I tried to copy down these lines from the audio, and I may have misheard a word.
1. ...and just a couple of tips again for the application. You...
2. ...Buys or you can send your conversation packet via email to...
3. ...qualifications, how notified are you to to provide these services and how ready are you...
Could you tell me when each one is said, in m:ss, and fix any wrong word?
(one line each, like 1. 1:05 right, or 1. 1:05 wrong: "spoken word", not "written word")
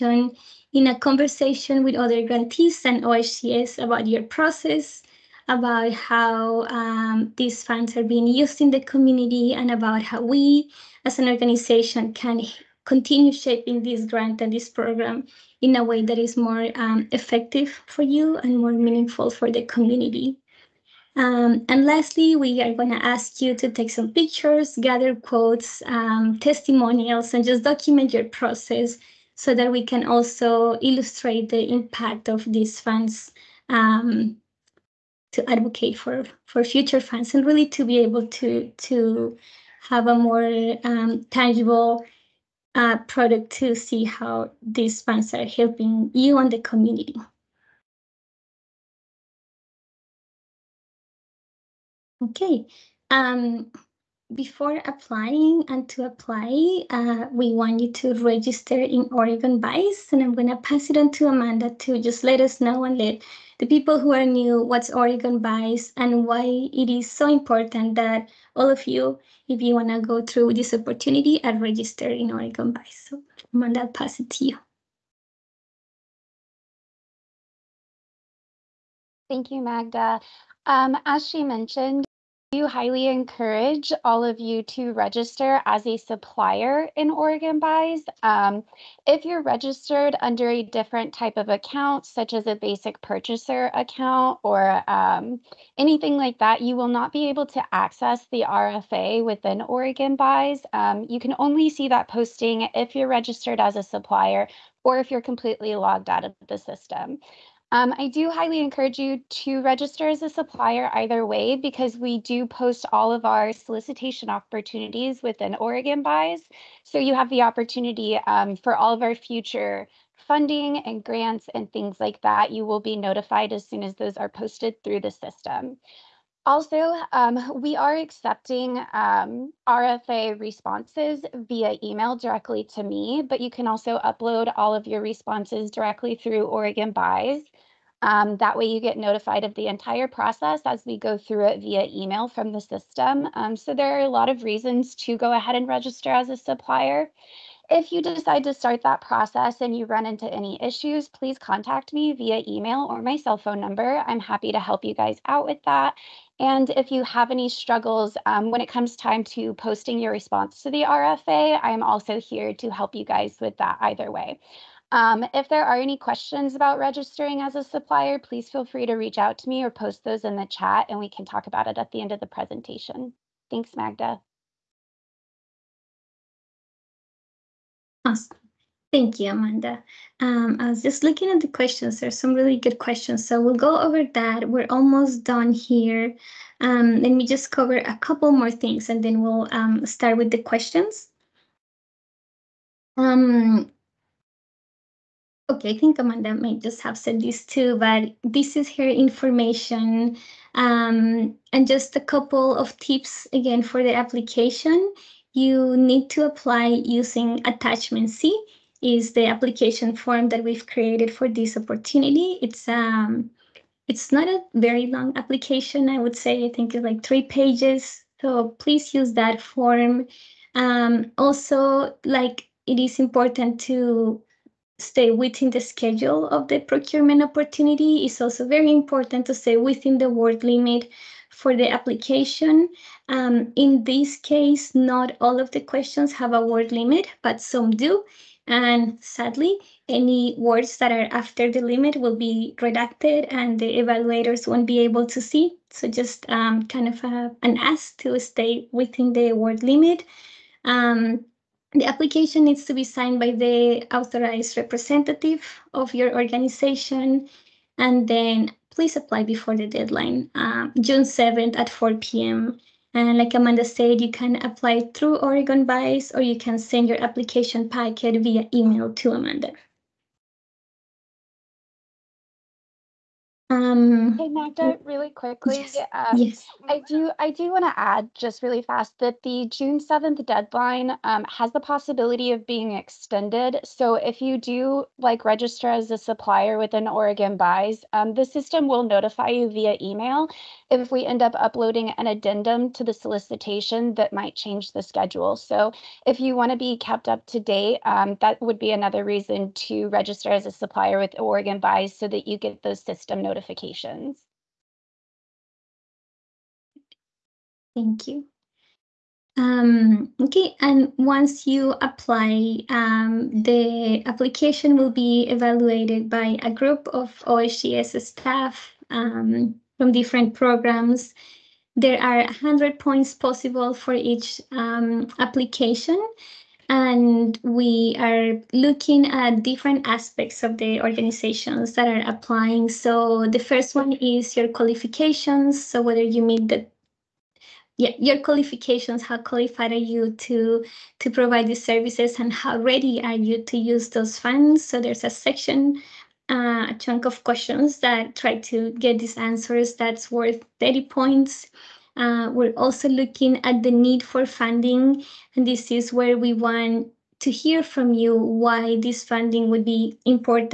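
1. 3:21 right
2. 4:25 wrong: "application", not "conversation"
3. 5:38 wrong: "qualified", not "notified".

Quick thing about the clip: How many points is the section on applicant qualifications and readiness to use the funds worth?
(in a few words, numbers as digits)
30 points.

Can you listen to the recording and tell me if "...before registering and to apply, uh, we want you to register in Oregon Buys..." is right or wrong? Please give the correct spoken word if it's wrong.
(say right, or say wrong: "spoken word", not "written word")
wrong: "applying", not "registering".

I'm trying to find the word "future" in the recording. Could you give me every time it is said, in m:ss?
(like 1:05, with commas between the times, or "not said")
0:36, 1:59.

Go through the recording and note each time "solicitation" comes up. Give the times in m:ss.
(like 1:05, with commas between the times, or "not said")
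1:53, 4:52.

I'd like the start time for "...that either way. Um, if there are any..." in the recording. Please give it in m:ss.
2:43.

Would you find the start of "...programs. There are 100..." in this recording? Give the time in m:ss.
5:20.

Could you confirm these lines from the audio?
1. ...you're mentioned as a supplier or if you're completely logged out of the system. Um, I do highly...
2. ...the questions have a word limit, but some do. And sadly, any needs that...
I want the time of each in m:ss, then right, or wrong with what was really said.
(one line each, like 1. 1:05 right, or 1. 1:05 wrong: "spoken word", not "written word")
1. 1:42 wrong: "registered", not "mentioned"
2. 3:55 wrong: "words", not "needs".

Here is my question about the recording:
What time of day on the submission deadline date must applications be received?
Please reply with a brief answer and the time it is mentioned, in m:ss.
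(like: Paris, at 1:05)
4 p.m., at 4:21.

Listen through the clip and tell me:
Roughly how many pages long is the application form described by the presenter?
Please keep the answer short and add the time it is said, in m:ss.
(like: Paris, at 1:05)
3 pages, at 3:37.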